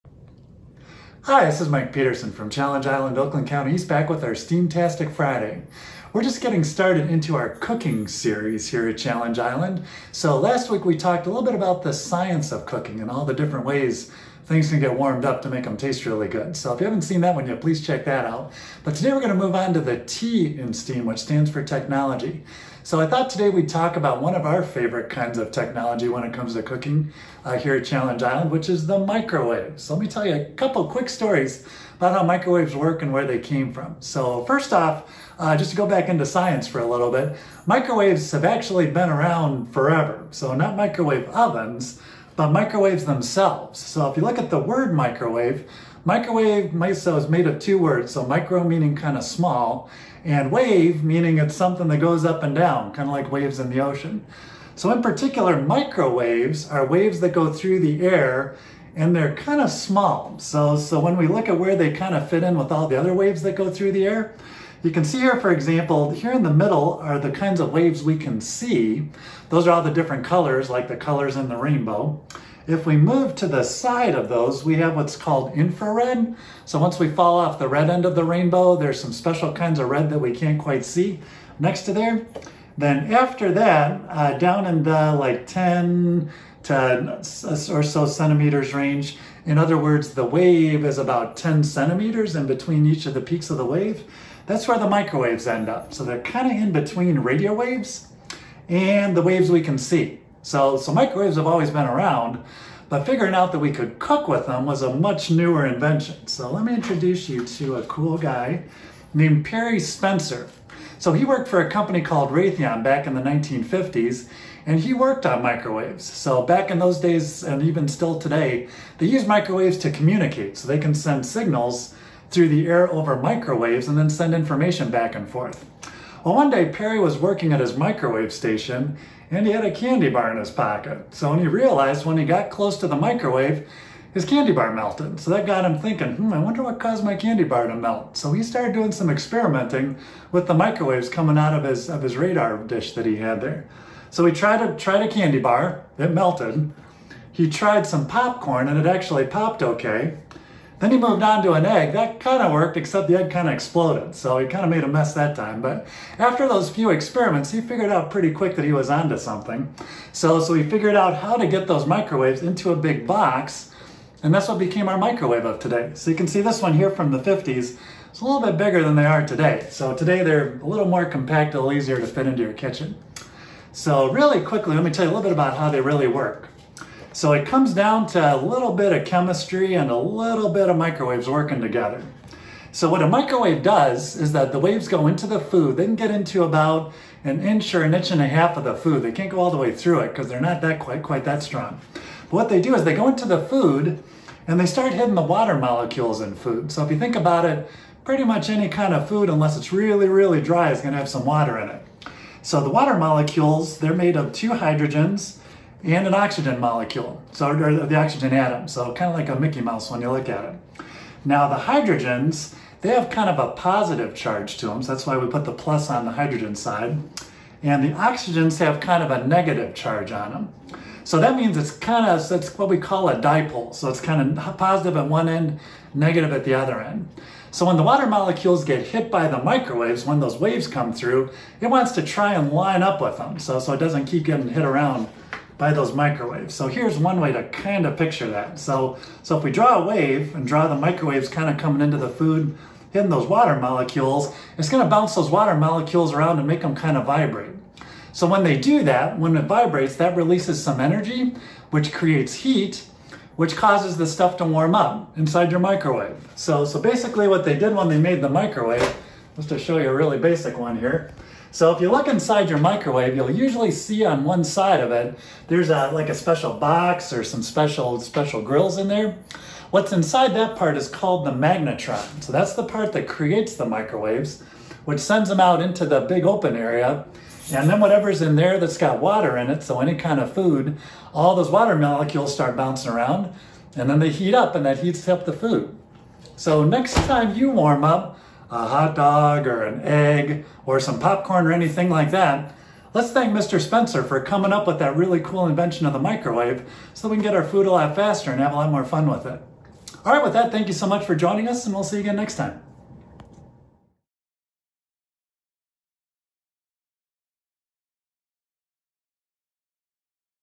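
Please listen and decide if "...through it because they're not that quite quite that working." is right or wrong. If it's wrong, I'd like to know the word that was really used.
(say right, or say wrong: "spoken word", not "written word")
wrong: "strong", not "working".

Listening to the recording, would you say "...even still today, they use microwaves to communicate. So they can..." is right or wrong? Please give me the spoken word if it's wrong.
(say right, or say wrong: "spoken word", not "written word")
right.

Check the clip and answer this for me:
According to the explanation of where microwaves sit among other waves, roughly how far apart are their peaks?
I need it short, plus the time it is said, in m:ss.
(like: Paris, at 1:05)
10 centimeters, at 1:31.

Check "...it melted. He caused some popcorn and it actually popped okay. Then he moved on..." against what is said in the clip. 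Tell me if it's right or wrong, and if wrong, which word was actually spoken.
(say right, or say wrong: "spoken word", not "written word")
wrong: "tried", not "caused".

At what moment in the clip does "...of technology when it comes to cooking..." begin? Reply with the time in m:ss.
0:25.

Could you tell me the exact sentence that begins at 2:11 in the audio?
So when he realized when he got close to the microwave, his candy bar melted.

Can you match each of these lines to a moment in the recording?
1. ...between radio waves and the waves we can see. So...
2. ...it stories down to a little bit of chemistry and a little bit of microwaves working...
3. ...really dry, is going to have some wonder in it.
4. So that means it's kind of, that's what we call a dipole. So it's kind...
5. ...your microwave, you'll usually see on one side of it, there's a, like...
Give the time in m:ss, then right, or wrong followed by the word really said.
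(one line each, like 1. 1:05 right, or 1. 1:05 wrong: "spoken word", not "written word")
1. 1:36 right
2. 2:57 wrong: "comes", not "stories"
3. 3:20 wrong: "water", not "wonder"
4. 3:41 right
5. 4:22 right.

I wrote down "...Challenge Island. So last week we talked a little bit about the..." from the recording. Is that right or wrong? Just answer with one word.
right.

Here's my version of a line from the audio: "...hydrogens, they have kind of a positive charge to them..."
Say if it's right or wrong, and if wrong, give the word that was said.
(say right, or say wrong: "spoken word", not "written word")
right.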